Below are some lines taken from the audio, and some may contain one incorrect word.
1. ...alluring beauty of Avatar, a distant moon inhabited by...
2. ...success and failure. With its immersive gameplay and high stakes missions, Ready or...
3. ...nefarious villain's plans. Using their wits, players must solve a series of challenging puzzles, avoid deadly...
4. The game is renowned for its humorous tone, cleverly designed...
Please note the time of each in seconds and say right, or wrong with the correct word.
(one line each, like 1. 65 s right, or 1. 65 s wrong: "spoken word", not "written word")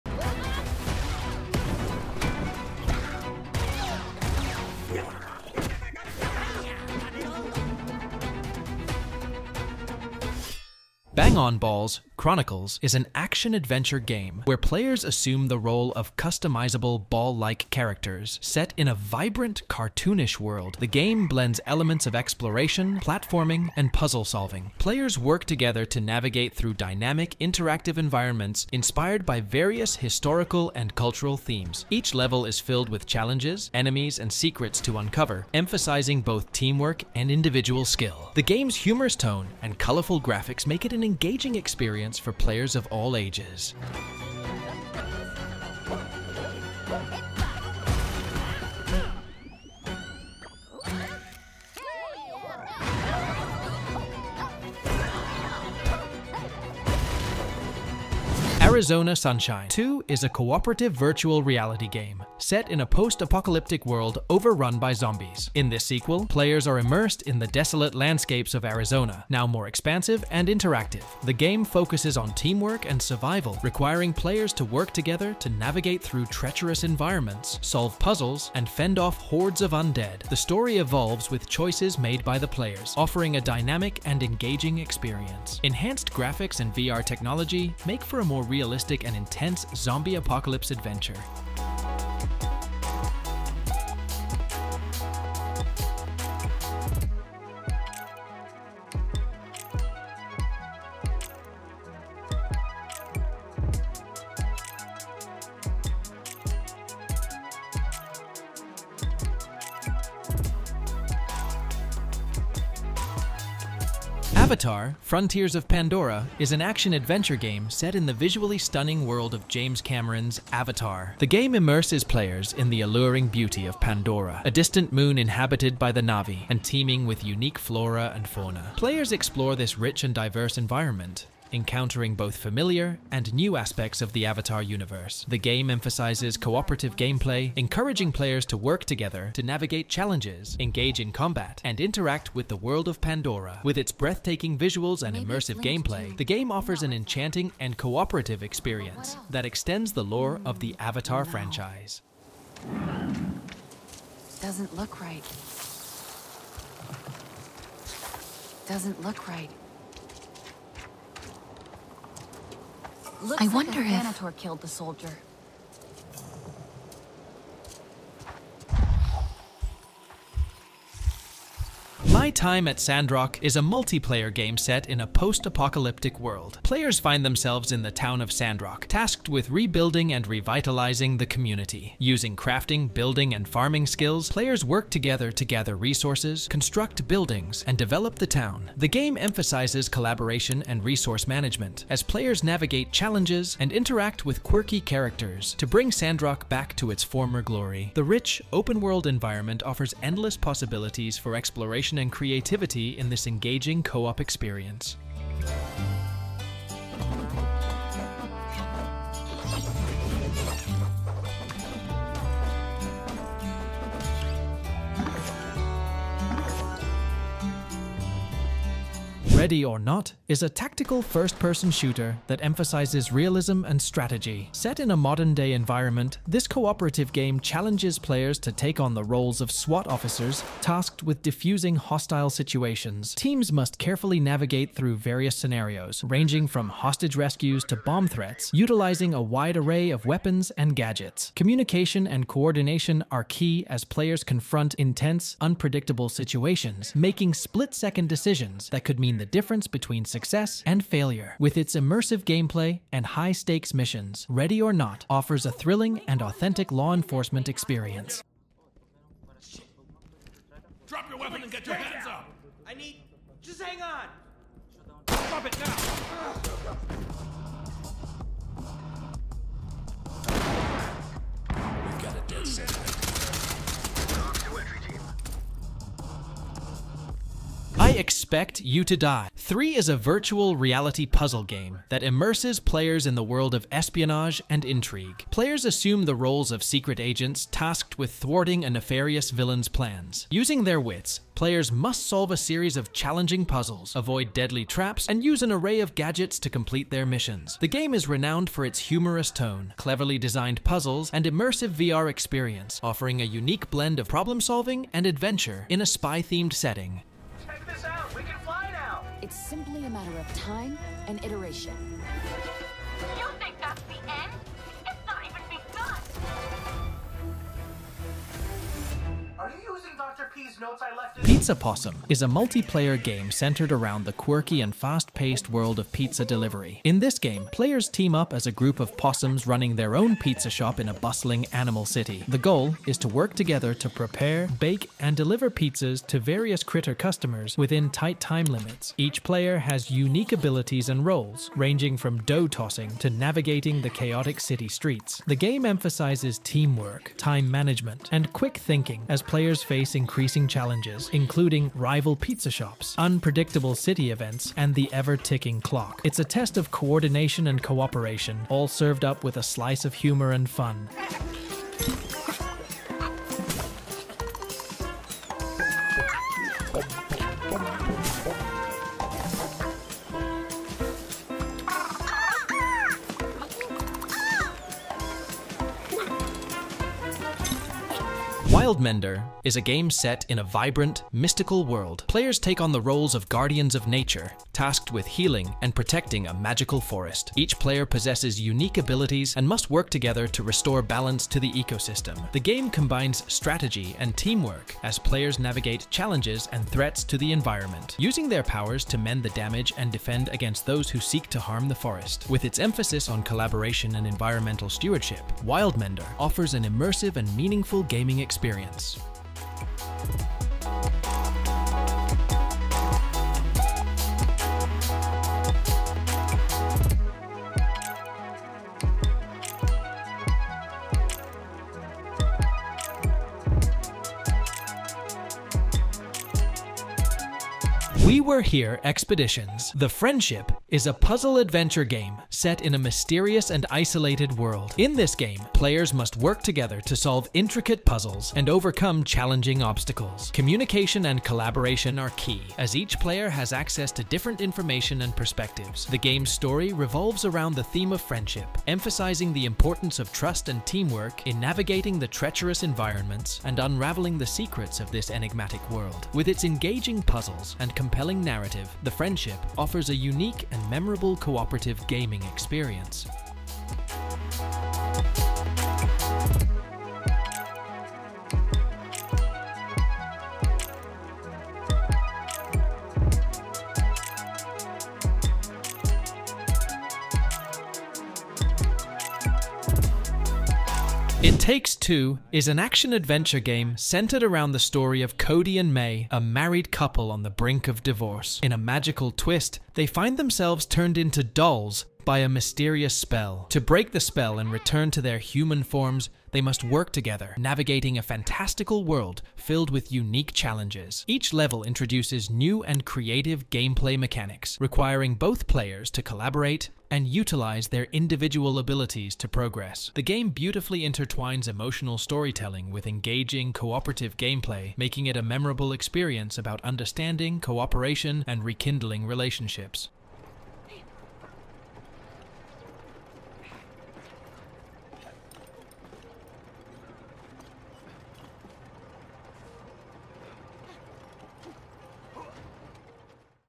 1. 122 s wrong: "Pandora", not "Avatar"
2. 250 s right
3. 288 s right
4. 297 s right.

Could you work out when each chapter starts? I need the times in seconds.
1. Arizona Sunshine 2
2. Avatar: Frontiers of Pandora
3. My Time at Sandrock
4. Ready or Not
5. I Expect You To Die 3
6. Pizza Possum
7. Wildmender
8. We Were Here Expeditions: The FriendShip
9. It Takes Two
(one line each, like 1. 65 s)
1. 58 s
2. 114 s
3. 171 s
4. 219 s
5. 277 s
6. 321 s
7. 378 s
8. 427 s
9. 481 s.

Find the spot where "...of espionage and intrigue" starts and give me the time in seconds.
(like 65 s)
283 s.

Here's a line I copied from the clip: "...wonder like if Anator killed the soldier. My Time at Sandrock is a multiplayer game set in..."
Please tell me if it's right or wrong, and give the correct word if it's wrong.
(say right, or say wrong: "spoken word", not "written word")
right.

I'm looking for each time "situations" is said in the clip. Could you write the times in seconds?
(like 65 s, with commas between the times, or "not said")
232 s, 246 s.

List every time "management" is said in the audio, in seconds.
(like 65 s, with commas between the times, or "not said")
191 s, 347 s.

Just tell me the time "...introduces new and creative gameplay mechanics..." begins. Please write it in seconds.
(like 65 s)
501 s.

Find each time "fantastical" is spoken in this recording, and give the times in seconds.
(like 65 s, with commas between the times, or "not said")
498 s.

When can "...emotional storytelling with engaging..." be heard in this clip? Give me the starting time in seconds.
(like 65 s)
511 s.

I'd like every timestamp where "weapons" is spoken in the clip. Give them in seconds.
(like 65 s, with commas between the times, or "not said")
240 s, 261 s.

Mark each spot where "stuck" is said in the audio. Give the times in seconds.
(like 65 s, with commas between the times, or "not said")
not said.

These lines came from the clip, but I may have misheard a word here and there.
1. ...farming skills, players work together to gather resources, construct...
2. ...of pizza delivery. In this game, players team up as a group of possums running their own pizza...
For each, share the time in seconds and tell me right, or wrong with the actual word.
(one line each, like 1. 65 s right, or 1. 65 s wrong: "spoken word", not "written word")
1. 183 s right
2. 325 s right.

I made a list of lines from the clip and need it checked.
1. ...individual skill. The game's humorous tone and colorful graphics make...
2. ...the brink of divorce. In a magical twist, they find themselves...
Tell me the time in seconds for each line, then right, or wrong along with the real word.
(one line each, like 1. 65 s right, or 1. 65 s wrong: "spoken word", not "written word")
1. 37 s right
2. 487 s right.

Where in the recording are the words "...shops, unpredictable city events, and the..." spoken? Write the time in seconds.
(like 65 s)
352 s.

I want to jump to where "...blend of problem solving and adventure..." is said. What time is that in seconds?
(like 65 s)
303 s.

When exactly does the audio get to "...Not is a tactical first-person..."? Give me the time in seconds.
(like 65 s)
219 s.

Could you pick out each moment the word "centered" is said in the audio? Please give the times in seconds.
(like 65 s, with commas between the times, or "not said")
323 s, 483 s.